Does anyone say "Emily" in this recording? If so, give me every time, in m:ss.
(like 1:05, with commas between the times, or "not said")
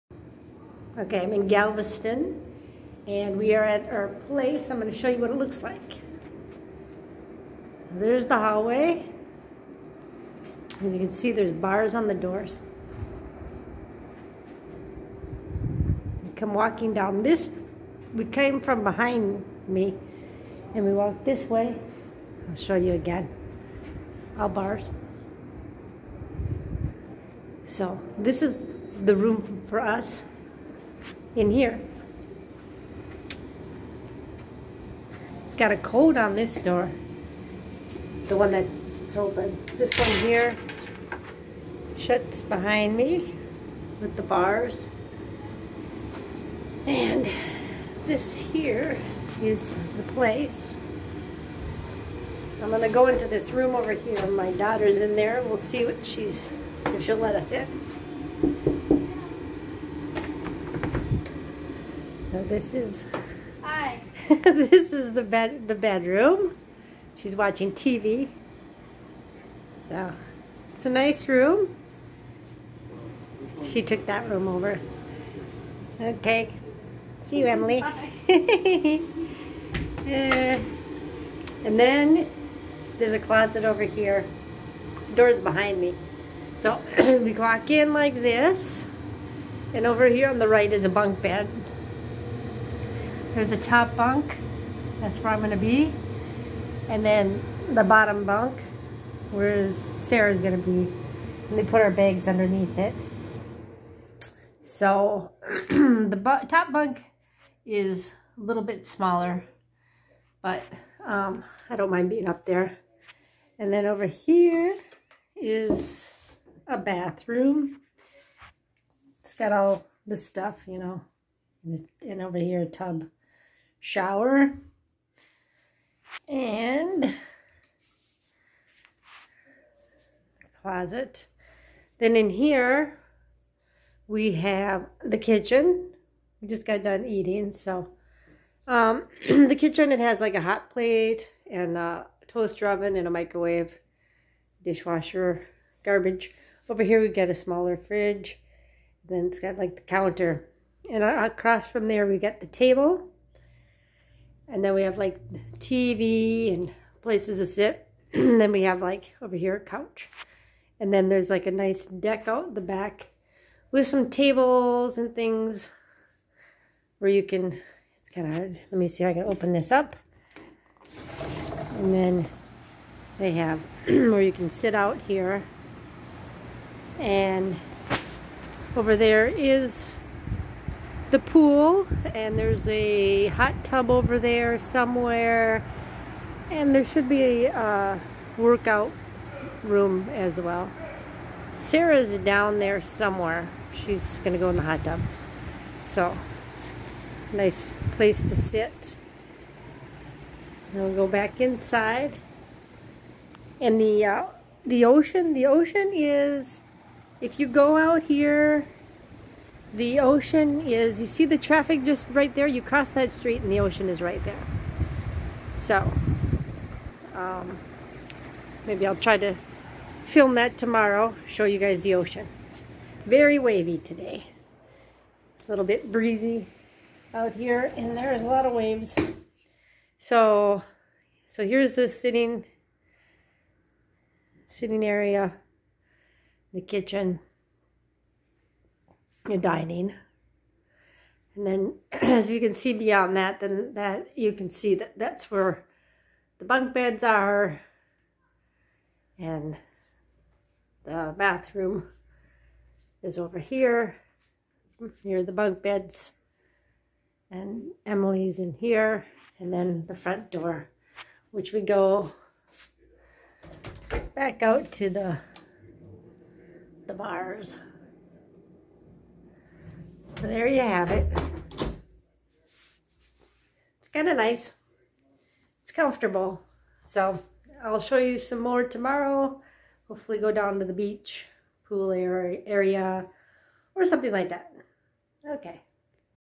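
1:17, 4:17.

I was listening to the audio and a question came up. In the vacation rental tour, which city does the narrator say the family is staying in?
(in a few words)
Galveston.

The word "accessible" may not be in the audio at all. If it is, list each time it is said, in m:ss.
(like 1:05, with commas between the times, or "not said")
not said.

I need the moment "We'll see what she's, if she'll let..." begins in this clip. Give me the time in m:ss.
0:55.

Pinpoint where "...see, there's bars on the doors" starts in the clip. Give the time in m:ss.
0:11.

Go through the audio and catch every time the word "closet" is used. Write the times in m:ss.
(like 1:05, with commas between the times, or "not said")
1:23, 2:10.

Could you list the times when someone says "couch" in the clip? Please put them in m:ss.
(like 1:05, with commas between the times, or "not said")
2:39.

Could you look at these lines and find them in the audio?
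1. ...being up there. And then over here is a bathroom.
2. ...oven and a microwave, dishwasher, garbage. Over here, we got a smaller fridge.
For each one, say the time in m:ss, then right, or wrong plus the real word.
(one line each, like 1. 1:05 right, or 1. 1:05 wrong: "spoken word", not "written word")
1. 1:52 right
2. 2:22 right.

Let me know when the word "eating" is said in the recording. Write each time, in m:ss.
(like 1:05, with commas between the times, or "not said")
2:17.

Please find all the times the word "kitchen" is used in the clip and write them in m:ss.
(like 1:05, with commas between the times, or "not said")
2:15, 2:19, 3:56.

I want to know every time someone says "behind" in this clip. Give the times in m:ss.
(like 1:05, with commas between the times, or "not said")
0:18, 0:42, 1:25.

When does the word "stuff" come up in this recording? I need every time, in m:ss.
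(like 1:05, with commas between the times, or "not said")
2:00.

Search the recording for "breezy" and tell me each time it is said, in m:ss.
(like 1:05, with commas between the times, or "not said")
3:45.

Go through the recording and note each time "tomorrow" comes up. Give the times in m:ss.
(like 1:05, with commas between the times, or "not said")
3:40, 4:38.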